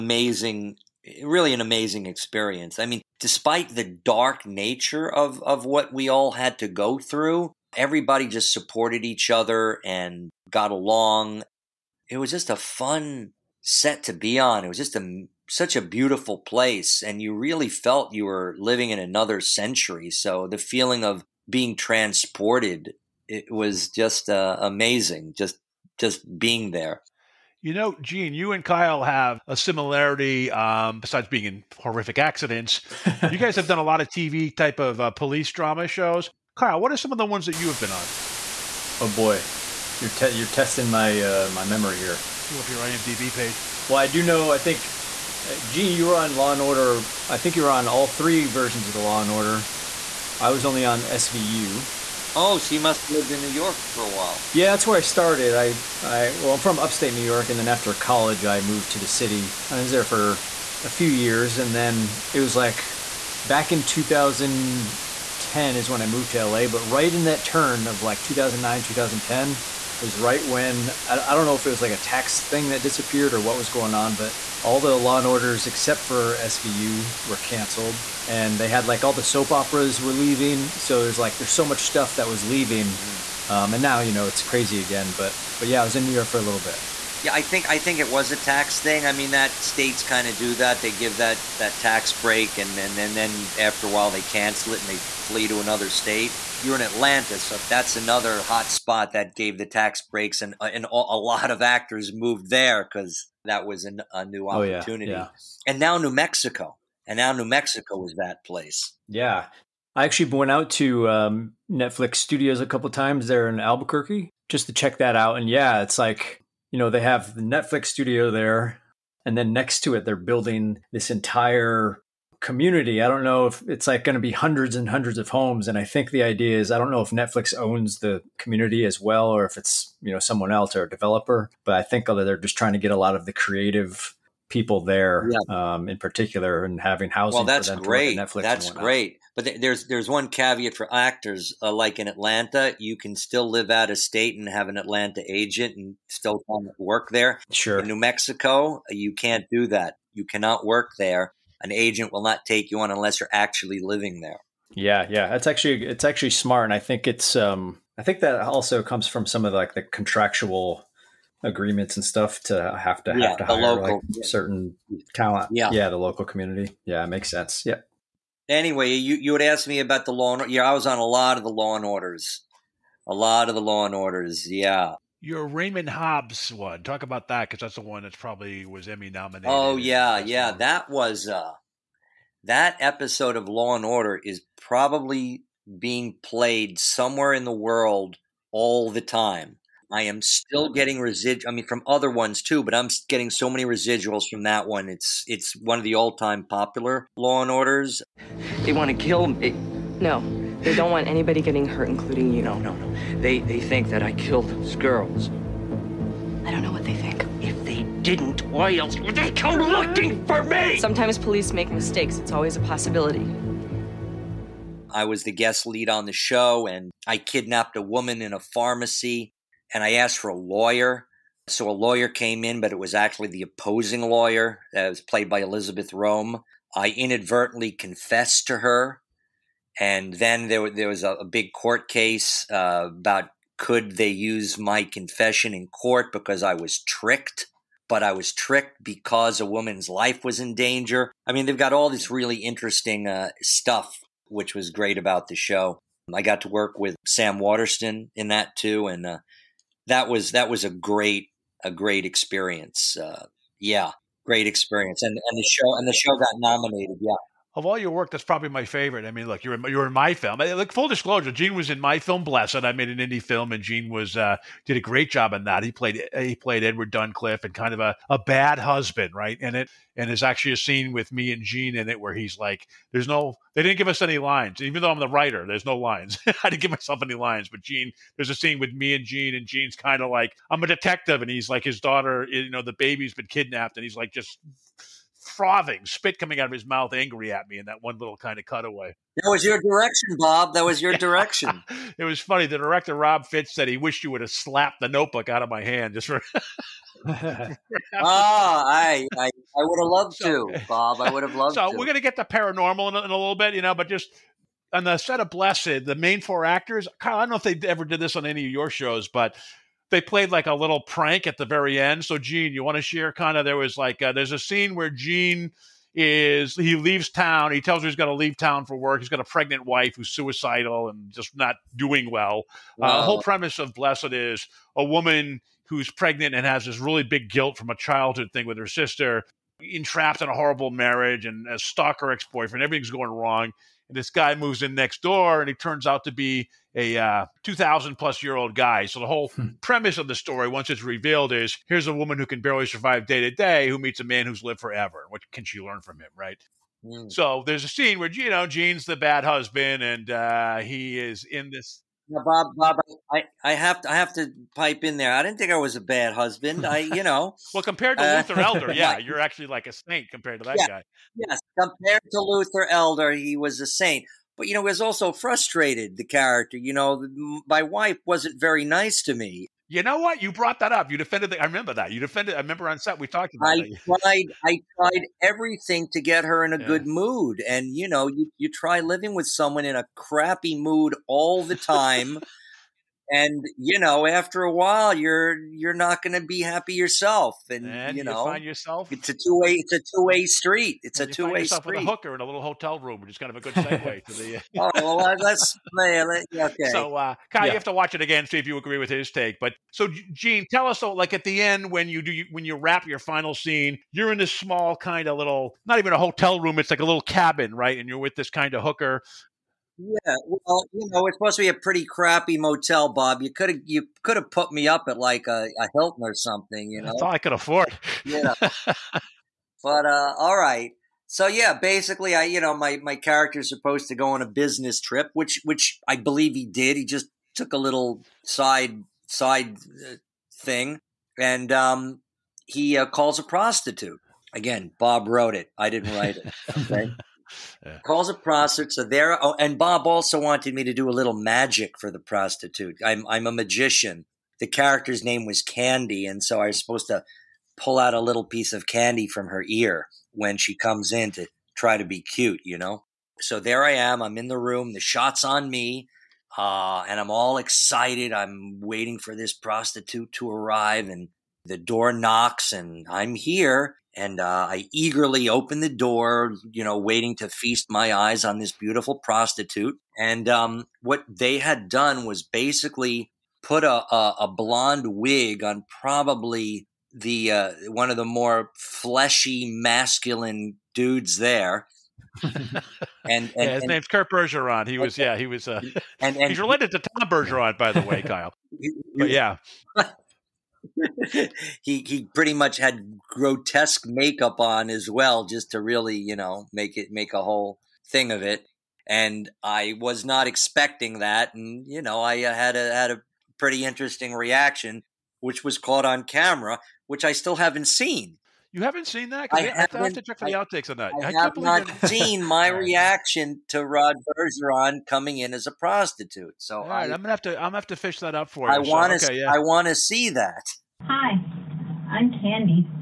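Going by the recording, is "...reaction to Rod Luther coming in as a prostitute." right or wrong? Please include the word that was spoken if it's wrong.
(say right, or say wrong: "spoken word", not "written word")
wrong: "Bergeron", not "Luther".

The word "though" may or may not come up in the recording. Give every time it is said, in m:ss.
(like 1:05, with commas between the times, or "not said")
4:34, 6:40.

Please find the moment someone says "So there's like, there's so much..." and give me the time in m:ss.
1:20.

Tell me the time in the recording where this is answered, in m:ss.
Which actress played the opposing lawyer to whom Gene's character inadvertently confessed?
3:45.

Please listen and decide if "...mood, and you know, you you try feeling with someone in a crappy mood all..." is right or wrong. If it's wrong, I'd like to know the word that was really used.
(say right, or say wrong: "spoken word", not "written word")
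wrong: "living", not "feeling".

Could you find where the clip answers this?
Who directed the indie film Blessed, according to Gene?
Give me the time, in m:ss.
4:52.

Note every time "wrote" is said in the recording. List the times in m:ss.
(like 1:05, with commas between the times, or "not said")
7:15.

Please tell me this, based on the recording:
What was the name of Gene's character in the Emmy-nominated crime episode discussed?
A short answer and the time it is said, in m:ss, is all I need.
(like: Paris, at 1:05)
Raymond Hobbs, at 2:55.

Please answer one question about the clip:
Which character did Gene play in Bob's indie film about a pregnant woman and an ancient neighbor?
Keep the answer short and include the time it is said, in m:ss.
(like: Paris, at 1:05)
Edward Duncliffe, at 4:26.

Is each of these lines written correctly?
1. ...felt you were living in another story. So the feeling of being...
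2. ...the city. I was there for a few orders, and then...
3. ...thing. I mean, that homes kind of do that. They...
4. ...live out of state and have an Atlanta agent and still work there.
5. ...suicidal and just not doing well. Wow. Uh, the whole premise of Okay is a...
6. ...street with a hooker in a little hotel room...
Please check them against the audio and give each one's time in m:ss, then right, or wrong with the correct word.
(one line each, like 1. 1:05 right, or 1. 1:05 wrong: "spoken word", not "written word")
1. 0:17 wrong: "century", not "story"
2. 0:58 wrong: "years", not "orders"
3. 1:28 wrong: "states", not "homes"
4. 2:23 right
5. 5:20 wrong: "Blessed", not "Okay"
6. 6:31 right.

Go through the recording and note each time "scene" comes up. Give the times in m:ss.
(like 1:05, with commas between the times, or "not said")
4:30, 4:38, 5:14, 5:47, 6:43.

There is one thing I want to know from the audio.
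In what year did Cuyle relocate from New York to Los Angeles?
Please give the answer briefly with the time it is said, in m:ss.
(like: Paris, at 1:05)
2010, at 1:05.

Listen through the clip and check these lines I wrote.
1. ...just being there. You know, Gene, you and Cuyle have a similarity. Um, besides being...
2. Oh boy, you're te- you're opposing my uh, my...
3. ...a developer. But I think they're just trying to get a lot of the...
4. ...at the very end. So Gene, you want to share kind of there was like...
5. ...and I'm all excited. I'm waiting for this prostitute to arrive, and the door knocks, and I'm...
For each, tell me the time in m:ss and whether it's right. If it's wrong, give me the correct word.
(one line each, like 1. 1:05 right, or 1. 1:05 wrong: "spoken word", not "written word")
1. 0:25 right
2. 0:38 wrong: "testing", not "opposing"
3. 2:10 right
4. 5:11 right
5. 7:36 right.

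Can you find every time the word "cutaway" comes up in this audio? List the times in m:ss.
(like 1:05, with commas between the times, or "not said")
4:48.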